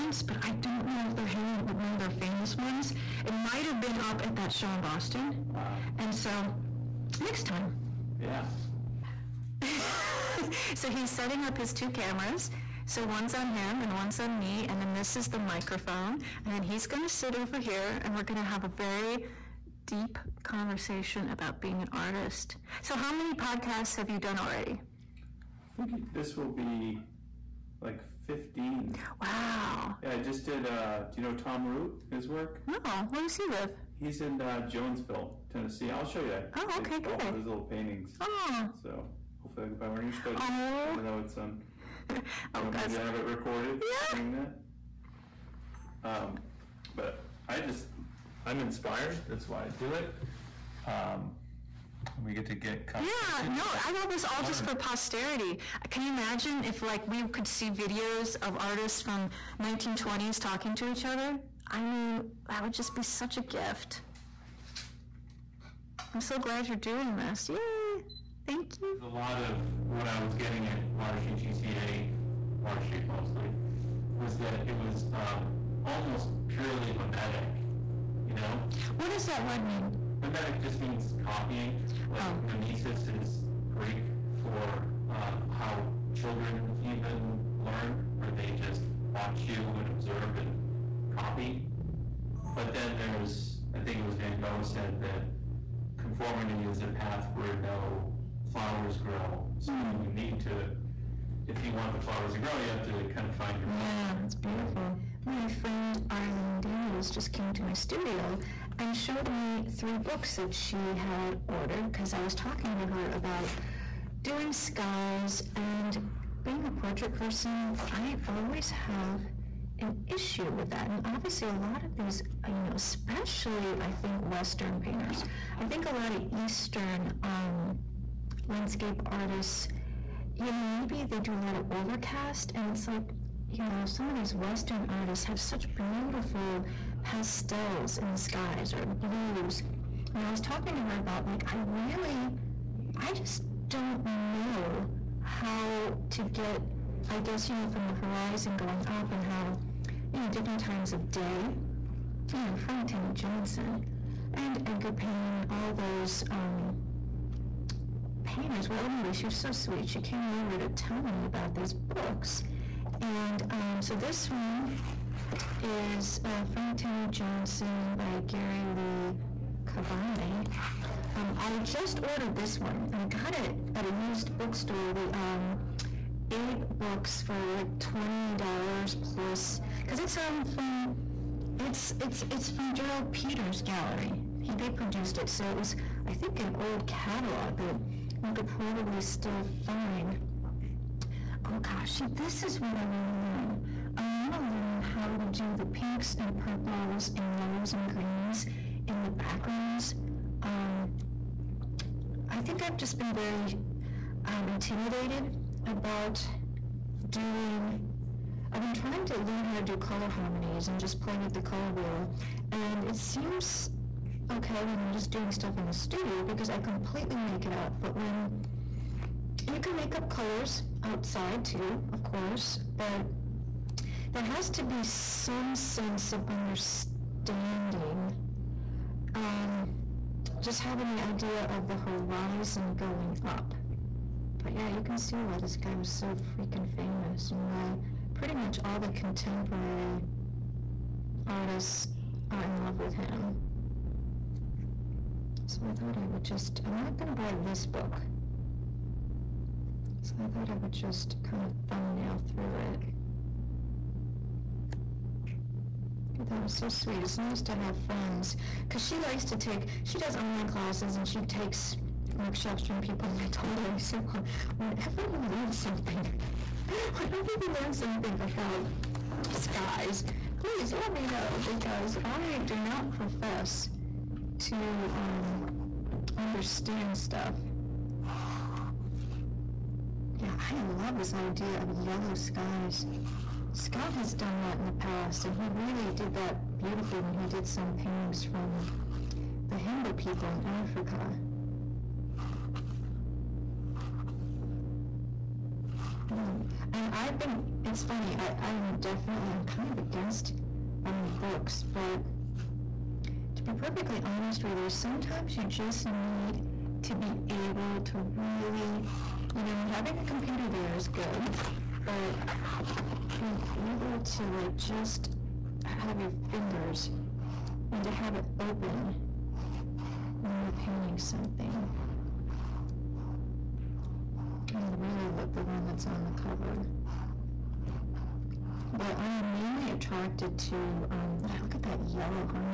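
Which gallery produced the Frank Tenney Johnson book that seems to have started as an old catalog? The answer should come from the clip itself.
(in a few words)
Gerald Peters Gallery.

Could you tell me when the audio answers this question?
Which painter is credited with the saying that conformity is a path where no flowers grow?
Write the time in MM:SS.
01:34.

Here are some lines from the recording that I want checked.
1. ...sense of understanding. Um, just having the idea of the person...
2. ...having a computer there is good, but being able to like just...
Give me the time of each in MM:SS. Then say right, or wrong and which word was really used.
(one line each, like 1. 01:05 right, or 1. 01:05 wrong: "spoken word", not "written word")
1. 03:45 wrong: "horizon", not "person"
2. 05:09 right.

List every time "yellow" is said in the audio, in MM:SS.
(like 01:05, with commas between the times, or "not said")
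03:17, 04:41, 05:31.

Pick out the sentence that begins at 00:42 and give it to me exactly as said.
Maybe I have it recorded yeah.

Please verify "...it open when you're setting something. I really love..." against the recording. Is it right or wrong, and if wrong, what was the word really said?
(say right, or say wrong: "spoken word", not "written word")
wrong: "painting", not "setting".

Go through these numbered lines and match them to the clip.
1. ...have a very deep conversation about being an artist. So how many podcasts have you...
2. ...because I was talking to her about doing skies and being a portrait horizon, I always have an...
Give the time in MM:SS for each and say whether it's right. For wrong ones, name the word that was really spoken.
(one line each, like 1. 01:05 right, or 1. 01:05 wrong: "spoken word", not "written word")
1. 00:18 right
2. 01:51 wrong: "person", not "horizon".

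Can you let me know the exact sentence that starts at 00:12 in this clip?
So one's on him and one's on me, and then this is the microphone.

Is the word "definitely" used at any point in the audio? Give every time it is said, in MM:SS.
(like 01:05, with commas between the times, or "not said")
04:58.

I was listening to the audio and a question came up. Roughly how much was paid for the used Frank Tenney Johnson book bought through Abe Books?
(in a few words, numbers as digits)
$20.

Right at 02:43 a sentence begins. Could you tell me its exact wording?
And um, so this one is uh, Frank Tenney Johnson by Gary Lee Kavame.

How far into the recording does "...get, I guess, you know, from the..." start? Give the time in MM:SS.
02:26.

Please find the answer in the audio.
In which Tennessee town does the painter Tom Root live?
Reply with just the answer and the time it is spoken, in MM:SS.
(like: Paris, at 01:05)
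Jonesville, at 00:34.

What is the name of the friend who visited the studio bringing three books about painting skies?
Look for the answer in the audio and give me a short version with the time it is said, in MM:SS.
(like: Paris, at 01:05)
Arlene Daniels, at 01:46.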